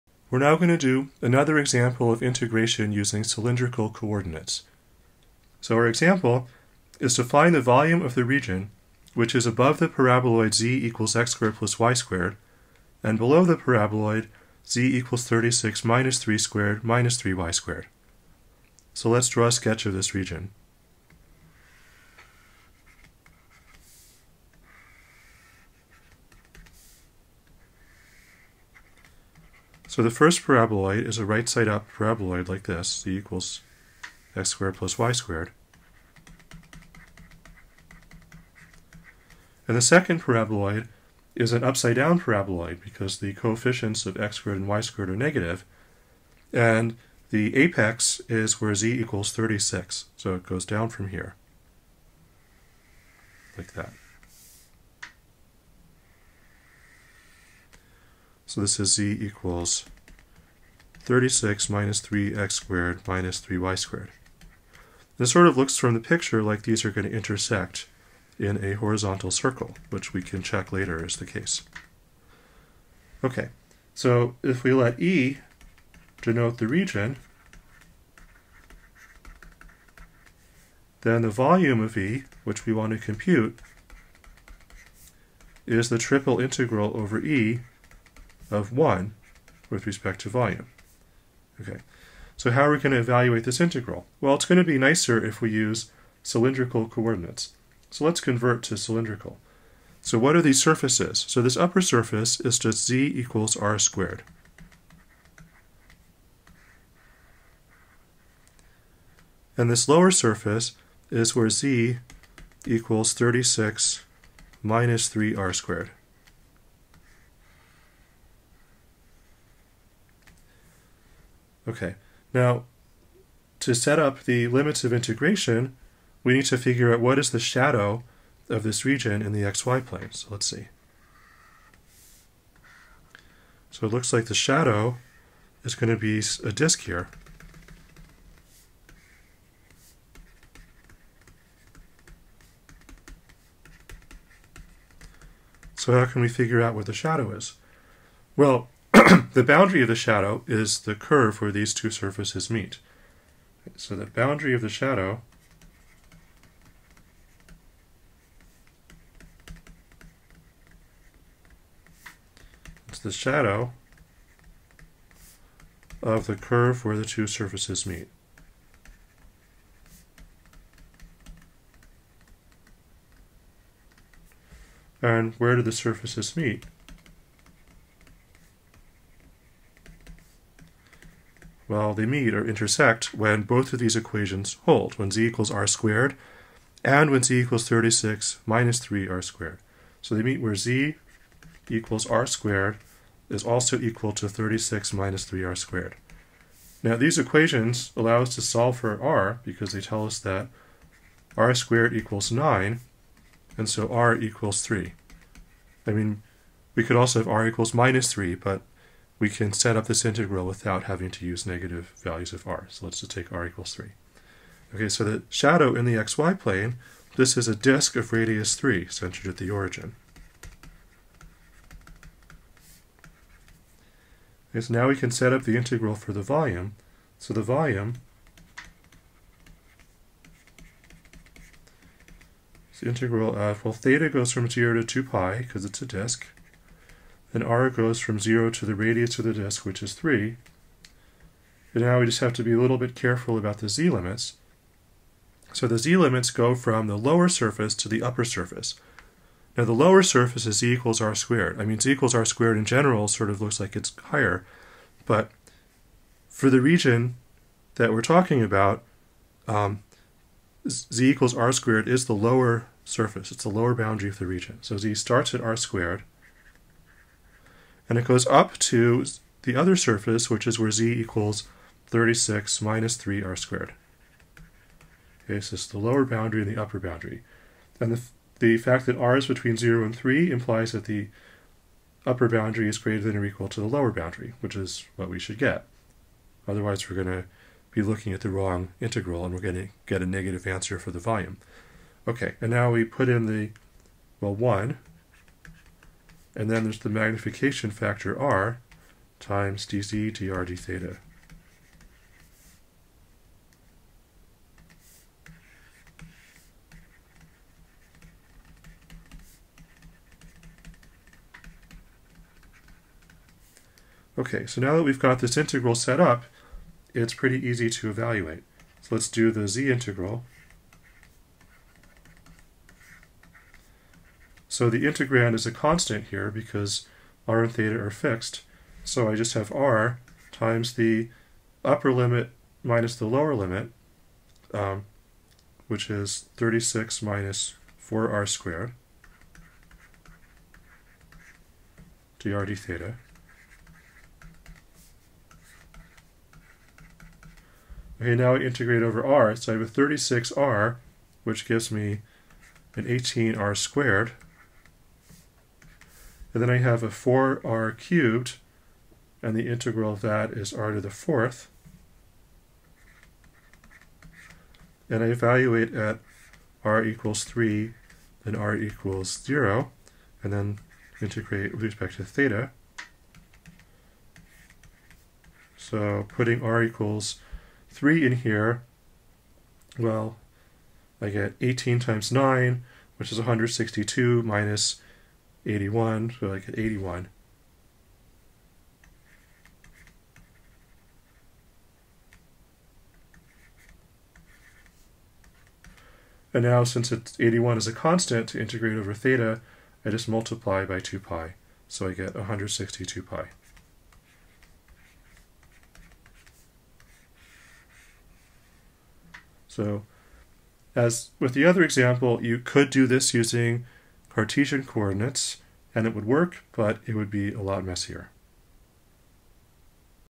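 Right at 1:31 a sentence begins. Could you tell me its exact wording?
Okay, so how are we going to evaluate this integral?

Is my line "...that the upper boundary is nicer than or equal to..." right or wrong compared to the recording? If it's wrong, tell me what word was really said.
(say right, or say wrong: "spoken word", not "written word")
wrong: "greater", not "nicer".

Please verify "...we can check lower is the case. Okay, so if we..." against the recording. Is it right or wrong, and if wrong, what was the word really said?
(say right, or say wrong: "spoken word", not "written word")
wrong: "later", not "lower".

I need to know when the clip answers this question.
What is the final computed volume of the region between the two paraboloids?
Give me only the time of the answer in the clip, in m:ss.
6:42.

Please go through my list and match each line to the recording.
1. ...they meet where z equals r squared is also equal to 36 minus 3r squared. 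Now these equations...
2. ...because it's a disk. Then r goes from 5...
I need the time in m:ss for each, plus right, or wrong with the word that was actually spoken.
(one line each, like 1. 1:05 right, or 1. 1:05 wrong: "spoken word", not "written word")
1. 3:10 right
2. 3:55 wrong: "0", not "5".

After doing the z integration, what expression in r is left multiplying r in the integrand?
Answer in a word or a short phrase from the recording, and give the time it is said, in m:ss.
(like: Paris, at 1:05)
36 minus 4r squared, at 5:36.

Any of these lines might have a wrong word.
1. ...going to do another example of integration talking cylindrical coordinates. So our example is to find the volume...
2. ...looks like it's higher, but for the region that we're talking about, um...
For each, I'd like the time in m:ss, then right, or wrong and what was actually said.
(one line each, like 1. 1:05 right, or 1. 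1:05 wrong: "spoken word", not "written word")
1. 0:00 wrong: "using", not "talking"
2. 4:13 right.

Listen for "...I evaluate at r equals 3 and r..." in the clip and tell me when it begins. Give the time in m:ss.
6:05.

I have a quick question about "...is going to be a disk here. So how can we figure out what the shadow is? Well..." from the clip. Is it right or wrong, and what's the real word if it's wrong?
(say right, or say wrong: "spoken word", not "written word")
right.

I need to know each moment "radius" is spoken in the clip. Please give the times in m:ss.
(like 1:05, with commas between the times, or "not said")
3:38, 3:58.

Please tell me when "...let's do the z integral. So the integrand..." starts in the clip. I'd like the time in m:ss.
5:18.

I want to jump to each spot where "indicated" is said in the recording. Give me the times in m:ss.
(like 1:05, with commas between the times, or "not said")
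not said.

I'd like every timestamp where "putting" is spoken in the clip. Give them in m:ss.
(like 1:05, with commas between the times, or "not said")
6:16.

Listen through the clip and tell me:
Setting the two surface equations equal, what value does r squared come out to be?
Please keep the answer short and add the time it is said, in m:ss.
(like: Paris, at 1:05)
9, at 3:21.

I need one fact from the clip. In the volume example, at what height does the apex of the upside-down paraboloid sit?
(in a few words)
36.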